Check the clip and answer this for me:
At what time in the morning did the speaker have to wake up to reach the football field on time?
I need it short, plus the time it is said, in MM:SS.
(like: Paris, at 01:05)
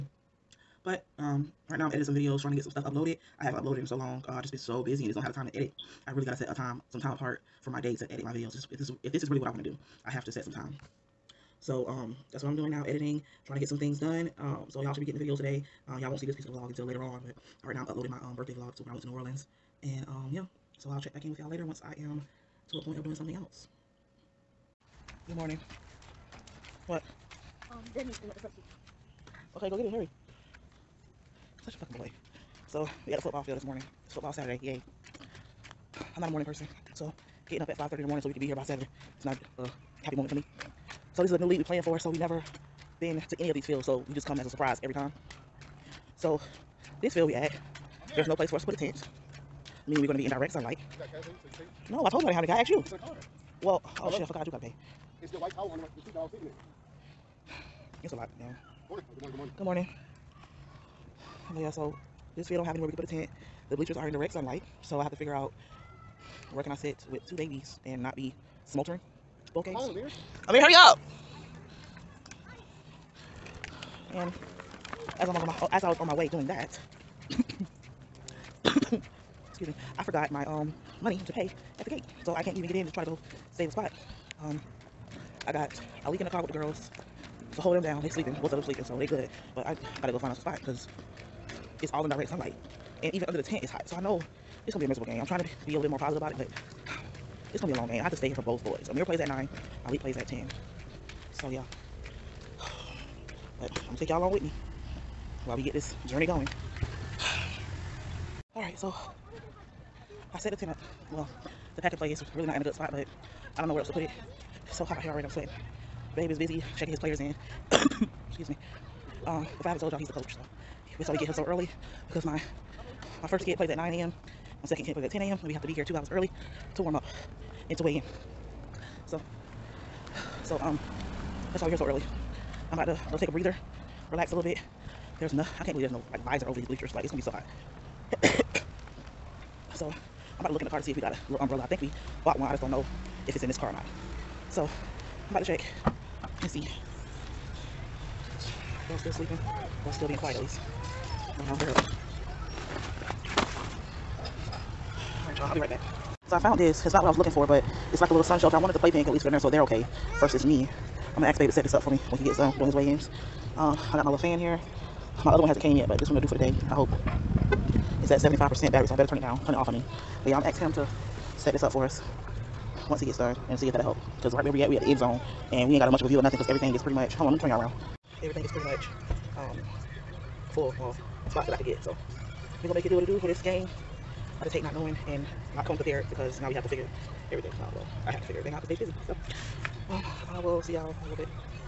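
5:30, at 00:37.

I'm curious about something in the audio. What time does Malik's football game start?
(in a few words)
10.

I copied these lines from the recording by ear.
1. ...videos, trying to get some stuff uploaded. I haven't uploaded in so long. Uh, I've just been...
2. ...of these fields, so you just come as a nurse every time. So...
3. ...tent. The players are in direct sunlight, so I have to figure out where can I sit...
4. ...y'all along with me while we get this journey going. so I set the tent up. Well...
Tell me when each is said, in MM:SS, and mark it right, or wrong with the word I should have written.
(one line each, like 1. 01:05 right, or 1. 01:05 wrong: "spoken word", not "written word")
1. 00:02 right
2. 00:43 wrong: "surprise", not "nurse"
3. 01:03 wrong: "bleachers", not "players"
4. 01:44 right.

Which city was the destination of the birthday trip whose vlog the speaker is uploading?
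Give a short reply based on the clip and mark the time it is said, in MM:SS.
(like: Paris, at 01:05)
New Orleans, at 00:19.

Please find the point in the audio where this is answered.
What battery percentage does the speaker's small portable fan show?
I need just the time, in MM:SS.
02:48.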